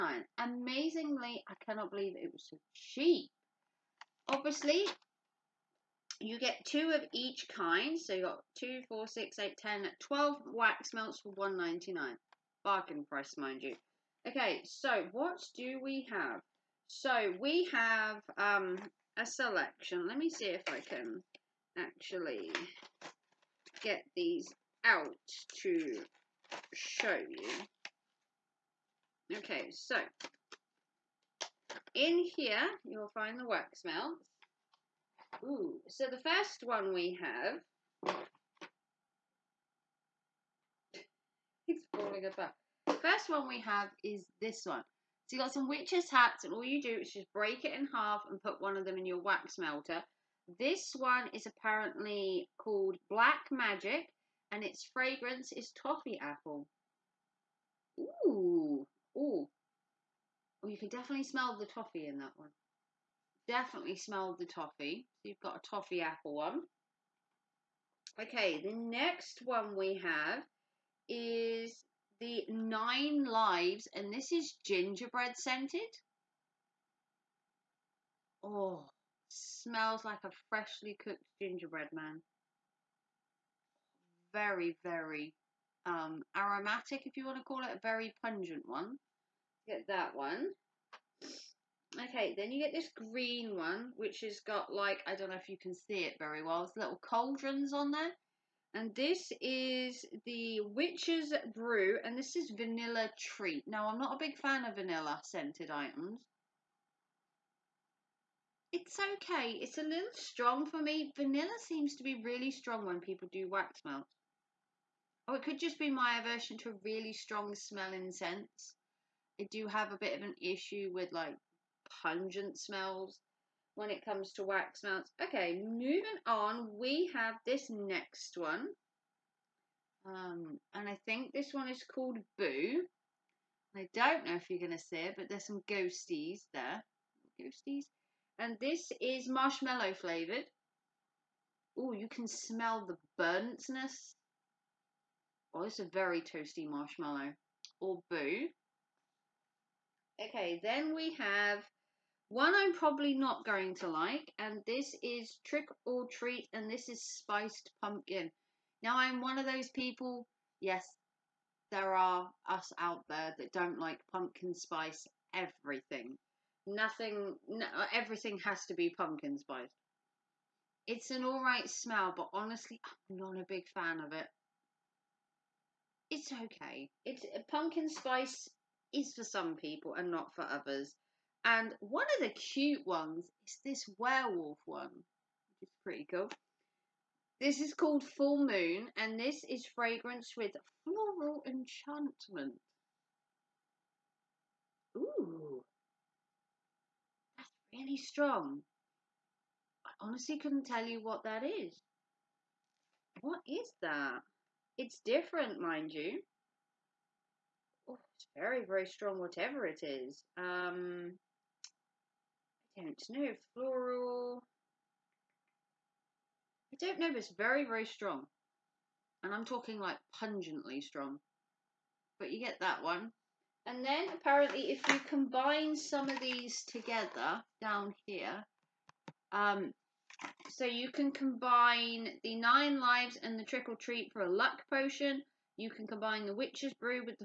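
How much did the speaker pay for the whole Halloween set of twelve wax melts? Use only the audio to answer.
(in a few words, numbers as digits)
1.99.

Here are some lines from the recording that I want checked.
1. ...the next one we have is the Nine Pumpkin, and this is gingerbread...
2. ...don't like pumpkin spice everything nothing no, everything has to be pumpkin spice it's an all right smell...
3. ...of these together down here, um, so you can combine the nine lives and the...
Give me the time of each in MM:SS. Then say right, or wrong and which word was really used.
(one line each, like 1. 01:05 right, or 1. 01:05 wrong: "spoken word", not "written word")
1. 01:08 wrong: "Lives", not "Pumpkin"
2. 02:43 right
3. 03:46 right.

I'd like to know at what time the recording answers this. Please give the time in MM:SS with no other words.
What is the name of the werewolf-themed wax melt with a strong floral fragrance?
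03:08.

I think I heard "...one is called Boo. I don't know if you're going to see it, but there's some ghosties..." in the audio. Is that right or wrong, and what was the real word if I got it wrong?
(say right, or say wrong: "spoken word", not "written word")
right.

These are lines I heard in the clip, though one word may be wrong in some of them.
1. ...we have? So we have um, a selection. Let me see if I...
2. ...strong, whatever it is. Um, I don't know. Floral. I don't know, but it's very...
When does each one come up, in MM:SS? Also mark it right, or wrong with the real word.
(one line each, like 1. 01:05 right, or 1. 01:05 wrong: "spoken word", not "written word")
1. 00:15 right
2. 03:28 right.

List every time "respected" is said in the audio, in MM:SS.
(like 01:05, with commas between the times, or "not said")
not said.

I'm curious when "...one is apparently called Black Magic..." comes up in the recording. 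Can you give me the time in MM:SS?
00:50.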